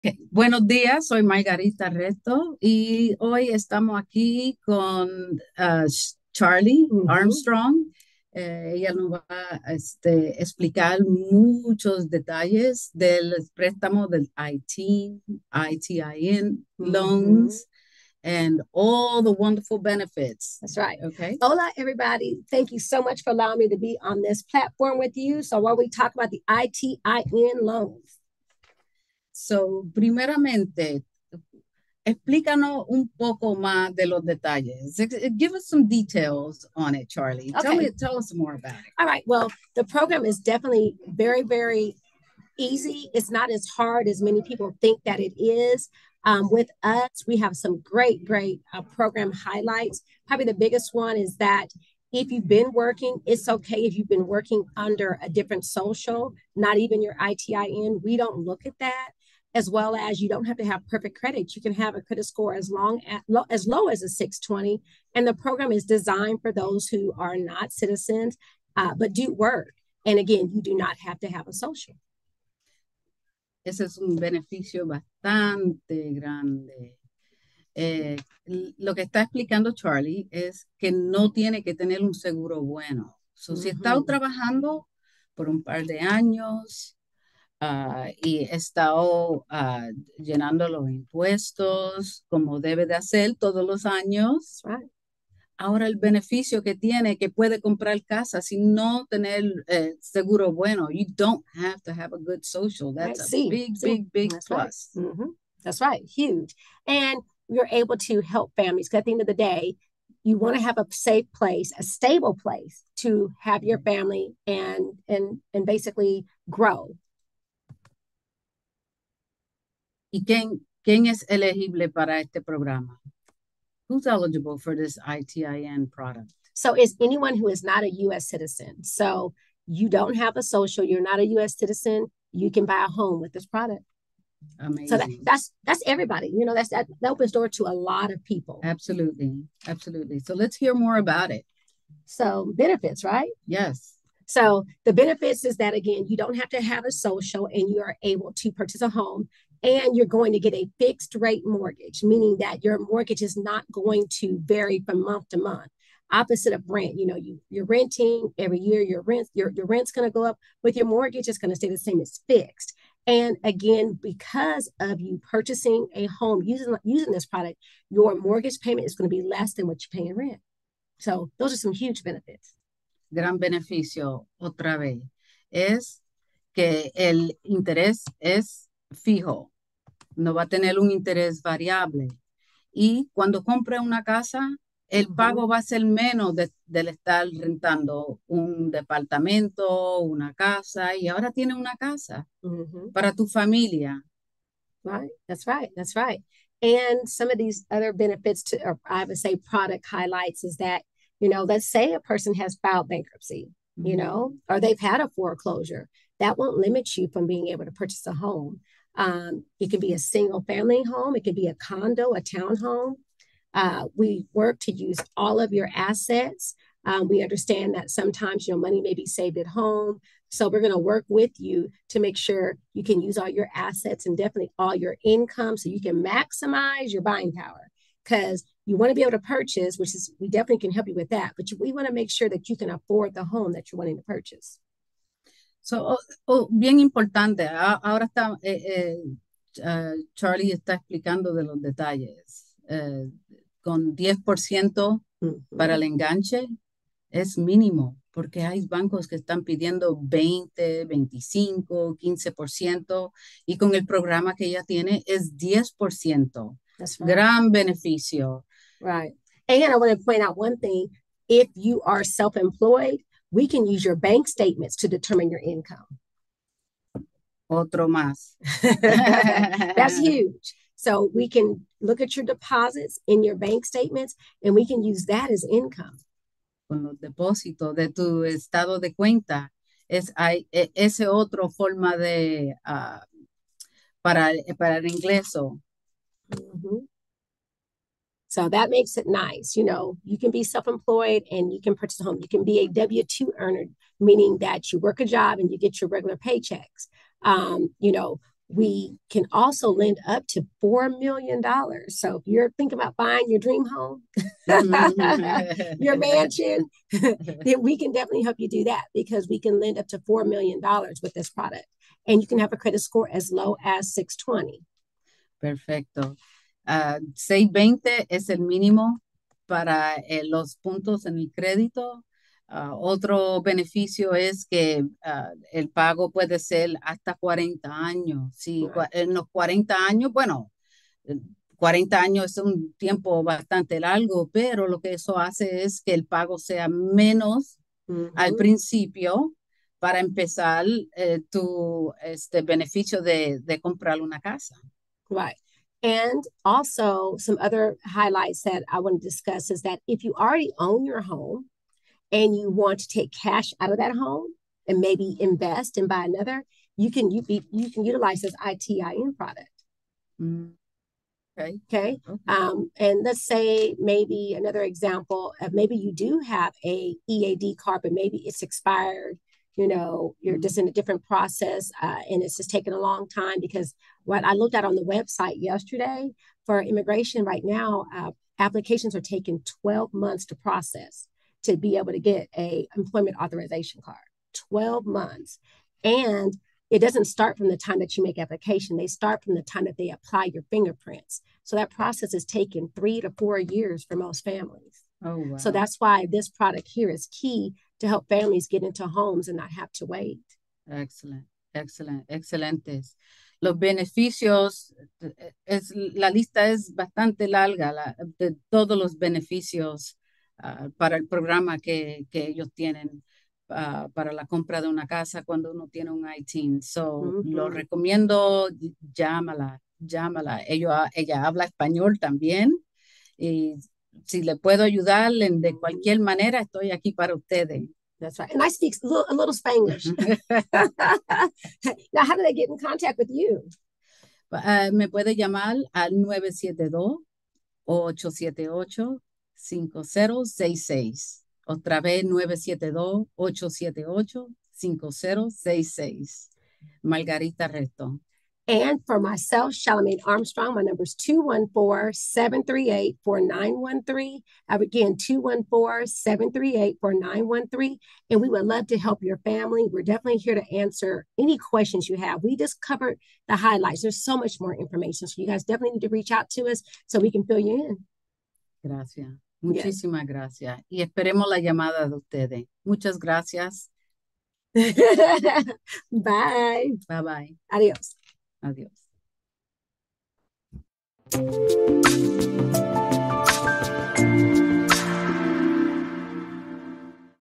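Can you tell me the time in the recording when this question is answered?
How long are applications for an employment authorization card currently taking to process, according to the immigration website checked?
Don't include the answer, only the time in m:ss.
6:18.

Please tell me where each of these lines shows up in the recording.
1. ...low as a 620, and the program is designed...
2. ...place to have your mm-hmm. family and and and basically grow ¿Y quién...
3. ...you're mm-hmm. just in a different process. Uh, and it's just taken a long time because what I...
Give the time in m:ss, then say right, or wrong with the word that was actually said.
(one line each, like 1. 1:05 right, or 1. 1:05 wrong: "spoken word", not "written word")
1. 1:03 right
2. 1:52 right
3. 6:10 right.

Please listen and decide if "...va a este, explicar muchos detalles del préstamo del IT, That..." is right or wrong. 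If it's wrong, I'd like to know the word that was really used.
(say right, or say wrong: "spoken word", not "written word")
wrong: "ITIN", not "That".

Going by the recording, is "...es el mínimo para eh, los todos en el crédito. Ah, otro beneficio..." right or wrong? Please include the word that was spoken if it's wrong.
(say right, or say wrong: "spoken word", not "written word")
wrong: "puntos", not "todos".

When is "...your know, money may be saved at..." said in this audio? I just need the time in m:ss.
3:38.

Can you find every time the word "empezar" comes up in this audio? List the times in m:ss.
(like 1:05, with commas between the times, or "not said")
5:39.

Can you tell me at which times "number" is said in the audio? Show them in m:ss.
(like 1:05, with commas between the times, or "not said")
7:30.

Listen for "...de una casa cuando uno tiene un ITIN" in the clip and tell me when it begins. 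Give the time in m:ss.
6:54.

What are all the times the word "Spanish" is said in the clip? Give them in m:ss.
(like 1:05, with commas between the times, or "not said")
7:09.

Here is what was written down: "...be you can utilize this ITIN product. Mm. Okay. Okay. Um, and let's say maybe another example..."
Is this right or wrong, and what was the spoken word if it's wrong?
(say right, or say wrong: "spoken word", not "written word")
right.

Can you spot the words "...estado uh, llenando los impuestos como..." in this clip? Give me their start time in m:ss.
1:28.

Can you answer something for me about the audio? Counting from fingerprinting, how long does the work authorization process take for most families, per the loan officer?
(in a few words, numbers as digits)
3 to 4 years.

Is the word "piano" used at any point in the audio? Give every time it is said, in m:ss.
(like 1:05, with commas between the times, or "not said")
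not said.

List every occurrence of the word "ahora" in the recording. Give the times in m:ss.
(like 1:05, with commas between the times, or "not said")
1:35, 3:11, 3:57.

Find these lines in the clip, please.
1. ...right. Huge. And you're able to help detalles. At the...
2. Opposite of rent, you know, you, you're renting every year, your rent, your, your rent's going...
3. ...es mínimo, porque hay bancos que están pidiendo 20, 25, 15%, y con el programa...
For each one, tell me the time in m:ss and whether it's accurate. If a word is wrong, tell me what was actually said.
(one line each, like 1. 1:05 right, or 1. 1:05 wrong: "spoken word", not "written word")
1. 1:45 wrong: "families", not "detalles"
2. 2:36 right
3. 4:07 right.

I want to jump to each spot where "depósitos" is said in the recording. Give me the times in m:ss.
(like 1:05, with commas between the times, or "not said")
4:36.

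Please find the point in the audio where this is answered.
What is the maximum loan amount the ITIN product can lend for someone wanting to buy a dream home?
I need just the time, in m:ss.
4:58.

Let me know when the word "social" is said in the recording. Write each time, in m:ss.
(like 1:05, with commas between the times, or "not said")
0:55, 1:11, 1:42, 2:10, 2:26.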